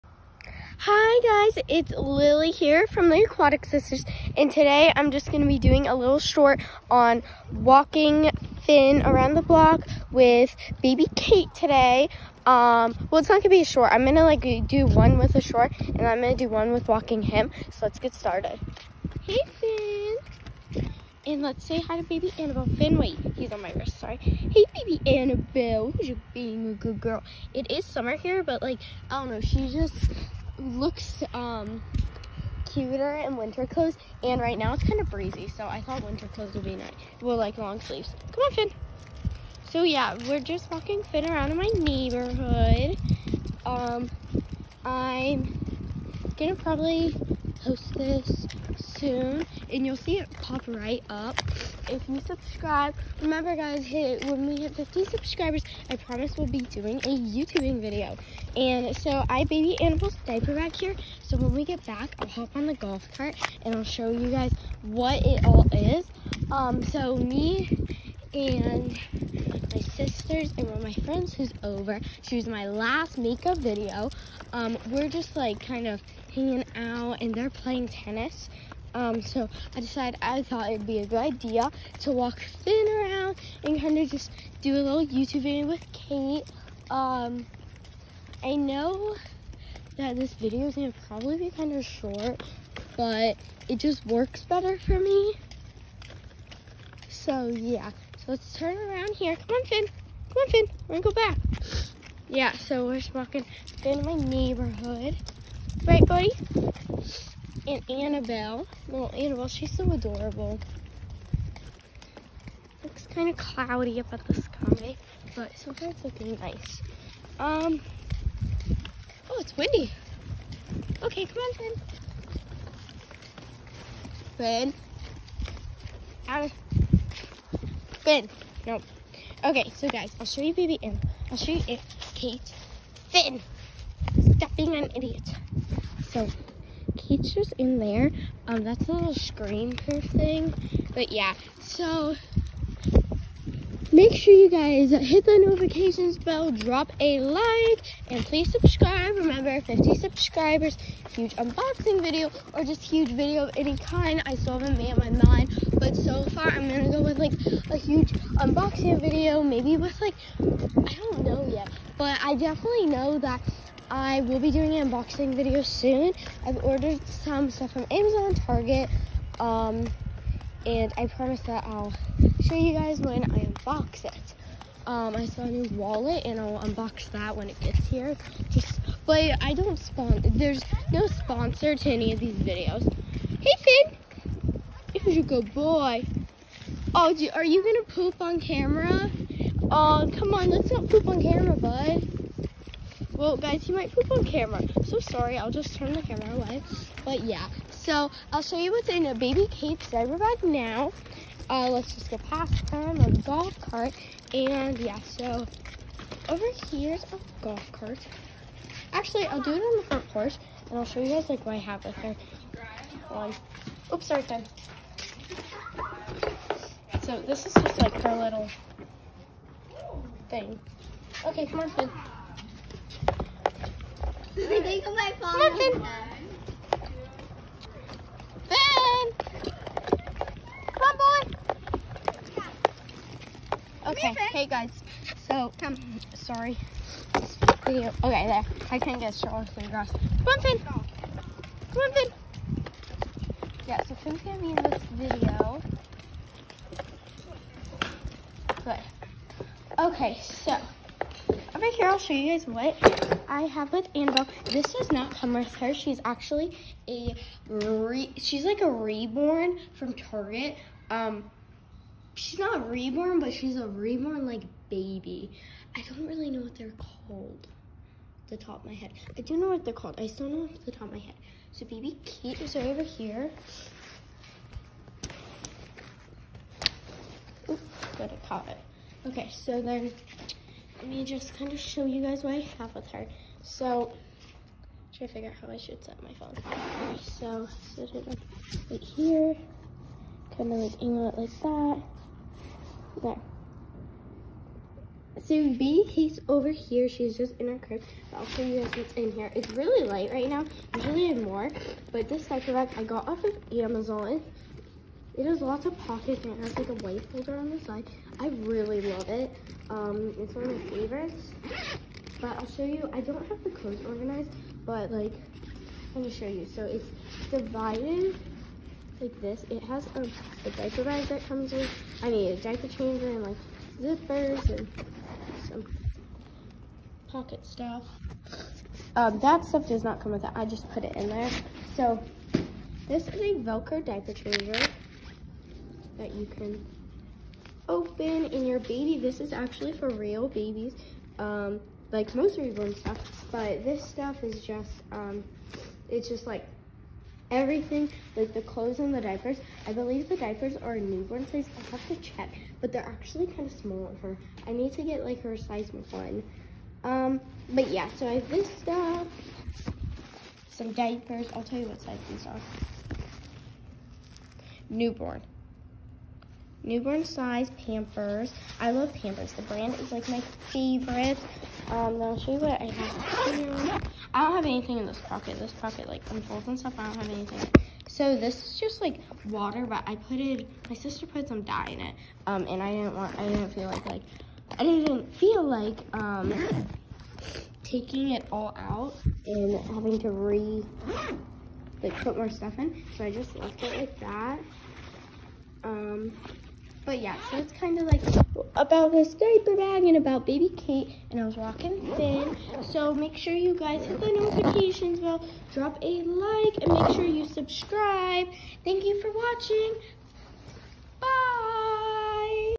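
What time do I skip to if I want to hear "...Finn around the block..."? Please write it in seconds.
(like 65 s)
8 s.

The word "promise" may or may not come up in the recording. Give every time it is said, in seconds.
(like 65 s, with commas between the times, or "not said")
55 s, 171 s.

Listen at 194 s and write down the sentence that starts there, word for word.
So sorry, I'll just turn the camera away.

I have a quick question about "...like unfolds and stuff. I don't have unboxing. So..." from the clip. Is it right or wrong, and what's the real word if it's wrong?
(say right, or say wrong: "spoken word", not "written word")
wrong: "anything", not "unboxing".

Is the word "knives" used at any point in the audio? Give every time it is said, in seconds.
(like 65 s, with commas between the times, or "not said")
not said.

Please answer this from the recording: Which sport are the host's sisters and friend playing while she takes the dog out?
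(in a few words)
Tennis.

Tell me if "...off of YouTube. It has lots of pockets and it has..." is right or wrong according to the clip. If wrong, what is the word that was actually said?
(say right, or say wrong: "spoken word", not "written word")
wrong: "Amazon", not "YouTube".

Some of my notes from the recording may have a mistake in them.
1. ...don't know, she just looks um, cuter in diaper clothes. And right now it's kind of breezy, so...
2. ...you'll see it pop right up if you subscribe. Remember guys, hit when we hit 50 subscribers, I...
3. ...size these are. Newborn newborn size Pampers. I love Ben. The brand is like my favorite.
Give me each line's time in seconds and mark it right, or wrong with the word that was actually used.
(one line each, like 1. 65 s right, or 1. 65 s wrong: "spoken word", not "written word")
1. 29 s wrong: "winter", not "diaper"
2. 49 s right
3. 361 s wrong: "Pampers", not "Ben".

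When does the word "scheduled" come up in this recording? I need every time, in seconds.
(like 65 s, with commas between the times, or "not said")
not said.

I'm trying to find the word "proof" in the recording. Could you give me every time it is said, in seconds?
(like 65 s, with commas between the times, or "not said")
139 s.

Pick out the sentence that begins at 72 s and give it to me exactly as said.
She was my last makeup video.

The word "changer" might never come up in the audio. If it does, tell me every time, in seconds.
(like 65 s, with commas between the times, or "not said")
322 s, 334 s.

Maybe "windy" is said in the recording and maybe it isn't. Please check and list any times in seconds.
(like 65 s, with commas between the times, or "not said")
119 s.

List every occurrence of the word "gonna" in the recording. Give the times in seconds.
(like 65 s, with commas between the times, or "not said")
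46 s, 90 s, 100 s, 156 s, 244 s, 316 s.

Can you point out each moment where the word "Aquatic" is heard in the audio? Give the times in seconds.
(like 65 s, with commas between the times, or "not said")
3 s.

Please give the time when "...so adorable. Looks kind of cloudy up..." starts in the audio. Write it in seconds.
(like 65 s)
109 s.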